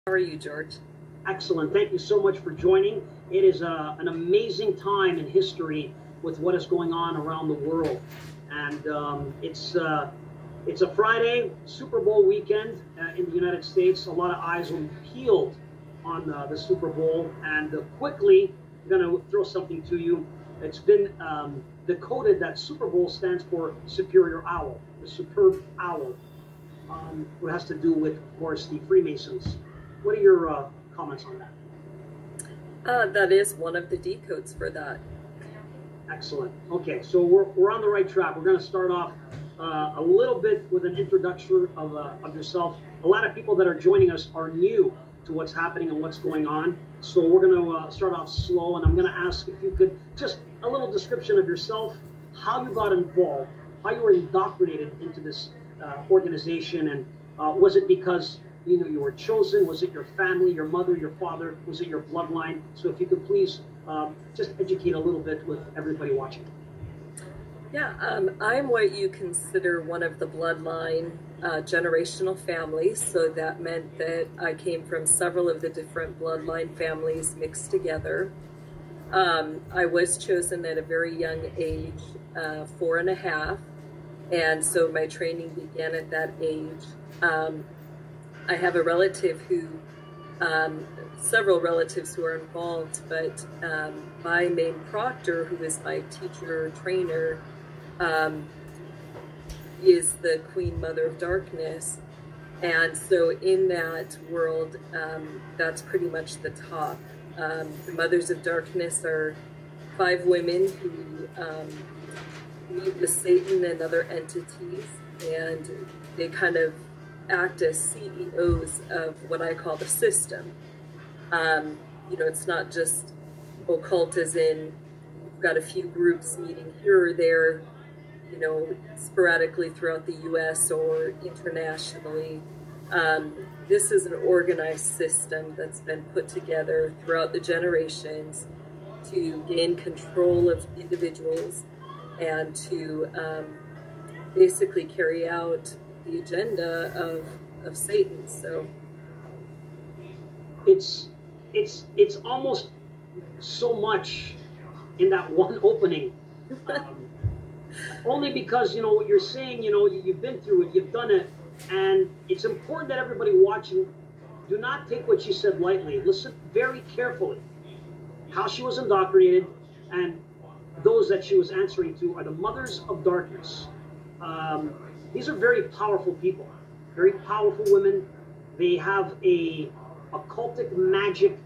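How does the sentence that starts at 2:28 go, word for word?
So it's it's it's almost so much in that one opening.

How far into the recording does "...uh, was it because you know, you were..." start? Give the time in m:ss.
0:57.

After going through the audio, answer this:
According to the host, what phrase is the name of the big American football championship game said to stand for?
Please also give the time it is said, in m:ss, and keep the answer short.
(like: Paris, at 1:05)
Superior Owl, at 0:23.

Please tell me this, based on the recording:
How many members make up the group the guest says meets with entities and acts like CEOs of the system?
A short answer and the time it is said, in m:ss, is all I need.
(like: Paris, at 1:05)
5, at 1:49.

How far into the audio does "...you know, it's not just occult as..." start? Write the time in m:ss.
2:02.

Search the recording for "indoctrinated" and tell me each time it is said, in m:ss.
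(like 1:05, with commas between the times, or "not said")
0:54, 2:48.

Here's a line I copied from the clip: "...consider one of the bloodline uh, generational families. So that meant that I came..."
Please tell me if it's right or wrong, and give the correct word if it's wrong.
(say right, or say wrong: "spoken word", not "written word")
right.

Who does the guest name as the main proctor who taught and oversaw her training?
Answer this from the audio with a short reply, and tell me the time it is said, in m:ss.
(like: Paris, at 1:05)
Queen Mother of Darkness, at 1:40.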